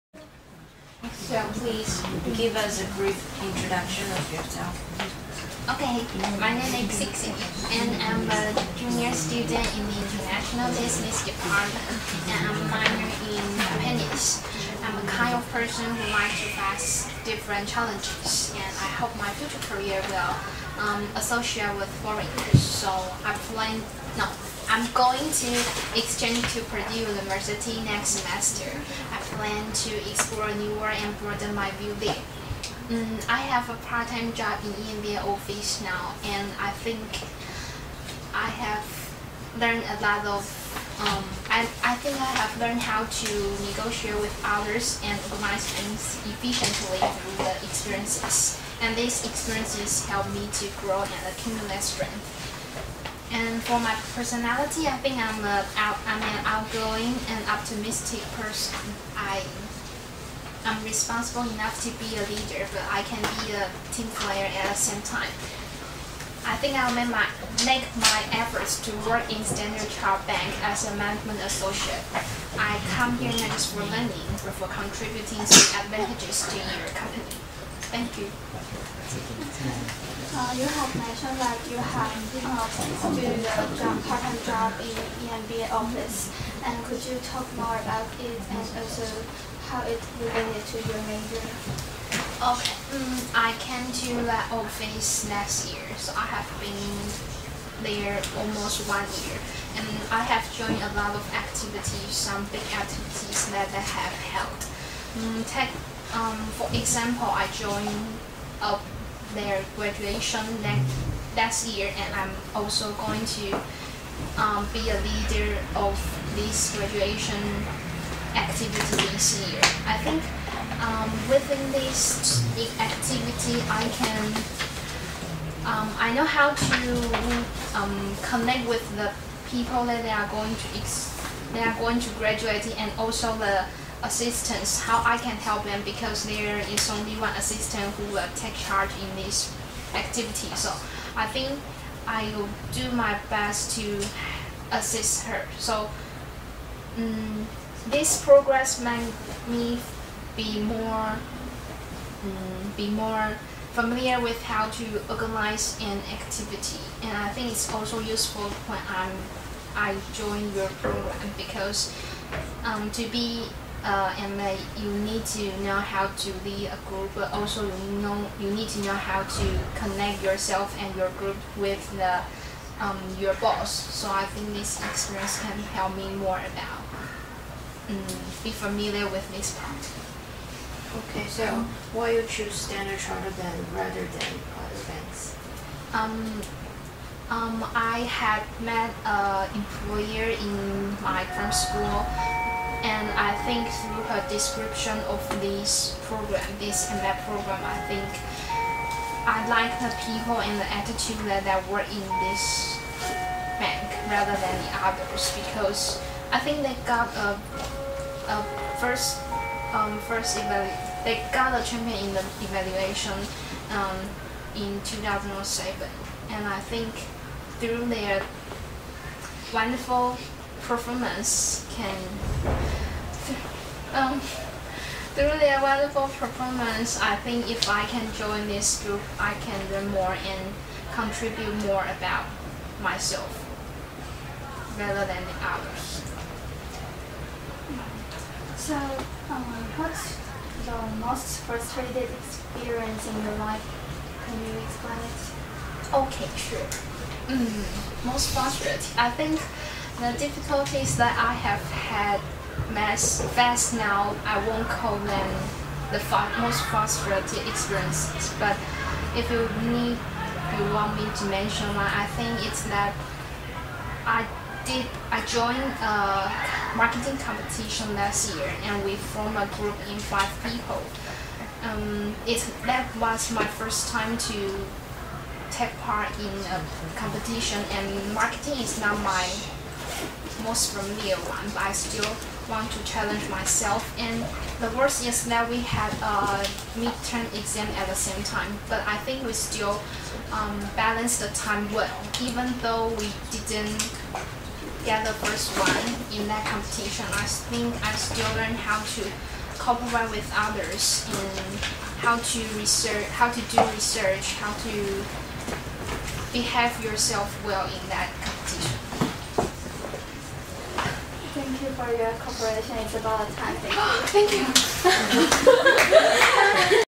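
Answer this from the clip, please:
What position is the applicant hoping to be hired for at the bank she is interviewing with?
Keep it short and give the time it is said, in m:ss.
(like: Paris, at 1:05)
management associate, at 1:10.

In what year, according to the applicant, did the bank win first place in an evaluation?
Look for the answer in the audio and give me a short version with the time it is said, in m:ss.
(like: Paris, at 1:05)
2007, at 3:34.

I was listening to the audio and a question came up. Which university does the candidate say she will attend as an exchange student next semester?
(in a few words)
Purdue University.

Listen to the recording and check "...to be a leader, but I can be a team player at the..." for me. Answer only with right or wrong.
right.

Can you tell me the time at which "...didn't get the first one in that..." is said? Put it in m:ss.
4:53.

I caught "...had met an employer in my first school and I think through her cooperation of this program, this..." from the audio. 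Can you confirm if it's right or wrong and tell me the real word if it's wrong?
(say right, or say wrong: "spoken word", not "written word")
wrong: "description", not "cooperation".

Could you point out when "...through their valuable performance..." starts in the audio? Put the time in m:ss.
3:45.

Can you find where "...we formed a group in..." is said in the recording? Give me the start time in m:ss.
4:28.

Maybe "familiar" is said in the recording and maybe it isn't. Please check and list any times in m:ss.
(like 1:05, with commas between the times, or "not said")
2:33, 2:58, 4:40.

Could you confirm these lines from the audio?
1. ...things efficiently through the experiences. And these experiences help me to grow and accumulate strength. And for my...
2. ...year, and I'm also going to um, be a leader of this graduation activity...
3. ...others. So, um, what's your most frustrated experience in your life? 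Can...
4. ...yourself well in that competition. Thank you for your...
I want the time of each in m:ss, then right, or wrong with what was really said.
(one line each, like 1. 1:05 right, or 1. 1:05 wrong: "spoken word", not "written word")
1. 0:45 right
2. 1:51 right
3. 3:55 right
4. 5:06 right.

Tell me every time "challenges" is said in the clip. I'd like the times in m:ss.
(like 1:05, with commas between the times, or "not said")
0:17, 4:42.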